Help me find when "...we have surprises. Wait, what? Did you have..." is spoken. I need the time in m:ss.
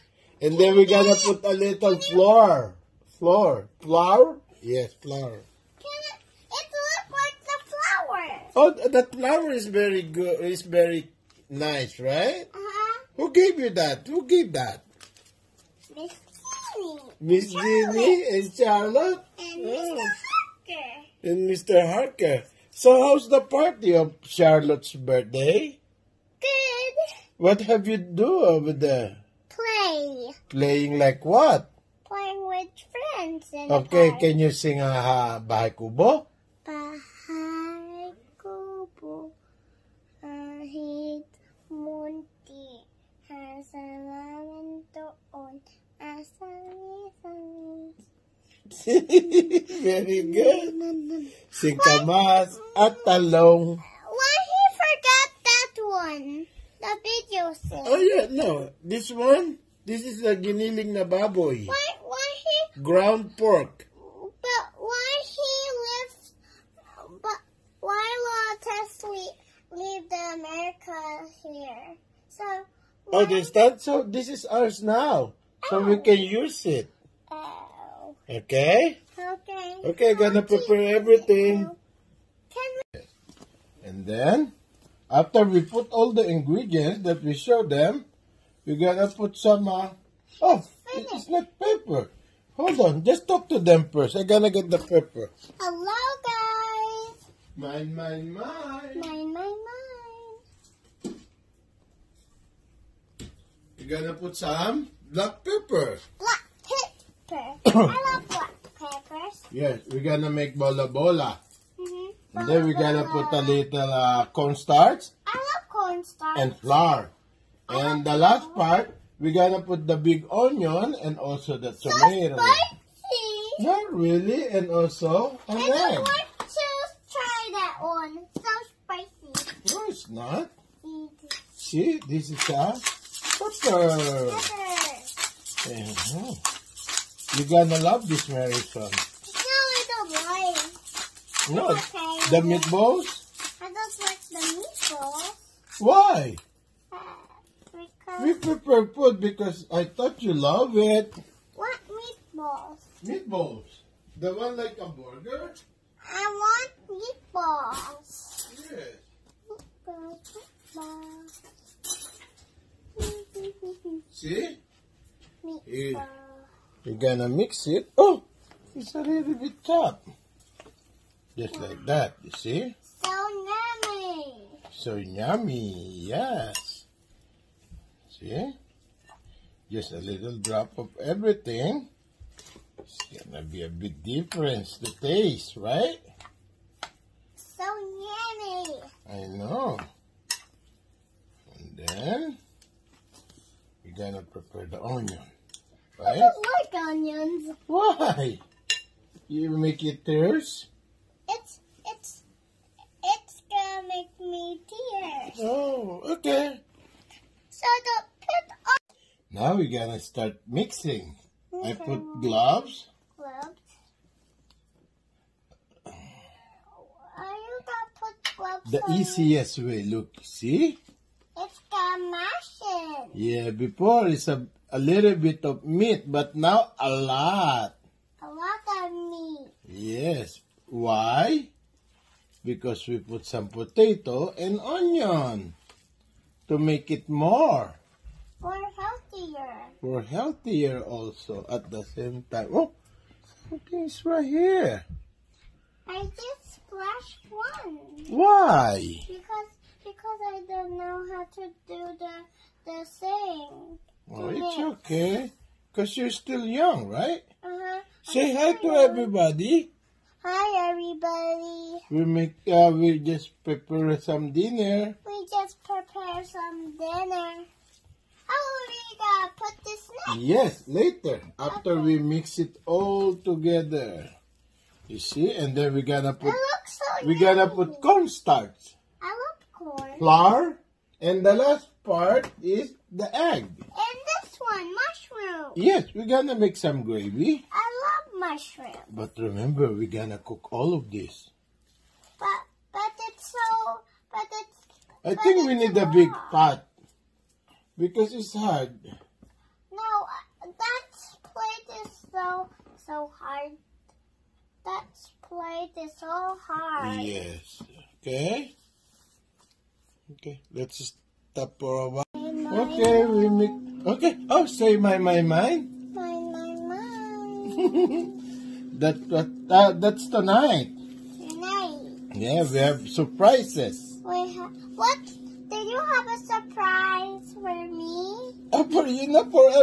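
5:22.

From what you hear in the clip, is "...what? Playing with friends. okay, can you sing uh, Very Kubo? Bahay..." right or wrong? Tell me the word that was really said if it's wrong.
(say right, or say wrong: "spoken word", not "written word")
wrong: "Bahay", not "Very".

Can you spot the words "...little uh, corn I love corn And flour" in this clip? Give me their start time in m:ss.
1:53.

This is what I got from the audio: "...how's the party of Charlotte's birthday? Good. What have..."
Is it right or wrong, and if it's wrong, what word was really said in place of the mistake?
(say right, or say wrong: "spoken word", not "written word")
right.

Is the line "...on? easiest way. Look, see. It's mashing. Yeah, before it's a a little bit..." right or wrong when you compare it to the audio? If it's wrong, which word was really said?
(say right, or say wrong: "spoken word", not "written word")
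right.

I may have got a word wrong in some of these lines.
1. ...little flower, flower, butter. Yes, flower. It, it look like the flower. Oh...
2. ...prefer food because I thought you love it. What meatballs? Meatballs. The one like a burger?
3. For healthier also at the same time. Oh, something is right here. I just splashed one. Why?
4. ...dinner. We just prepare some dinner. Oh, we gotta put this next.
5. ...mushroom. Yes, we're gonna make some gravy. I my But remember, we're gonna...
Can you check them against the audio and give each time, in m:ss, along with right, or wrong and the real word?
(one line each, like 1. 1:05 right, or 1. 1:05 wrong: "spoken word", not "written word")
1. 0:01 wrong: "flower", not "butter"
2. 2:28 right
3. 3:59 right
4. 4:24 right
5. 4:44 right.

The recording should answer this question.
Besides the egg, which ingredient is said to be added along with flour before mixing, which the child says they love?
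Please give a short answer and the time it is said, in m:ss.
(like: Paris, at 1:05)
cornstarch, at 4:37.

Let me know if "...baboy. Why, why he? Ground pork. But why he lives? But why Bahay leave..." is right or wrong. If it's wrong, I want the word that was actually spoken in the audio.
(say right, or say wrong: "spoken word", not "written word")
wrong: "Lotus", not "Bahay".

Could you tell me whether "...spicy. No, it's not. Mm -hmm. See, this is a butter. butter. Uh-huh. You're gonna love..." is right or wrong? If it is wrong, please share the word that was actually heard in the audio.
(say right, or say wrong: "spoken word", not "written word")
right.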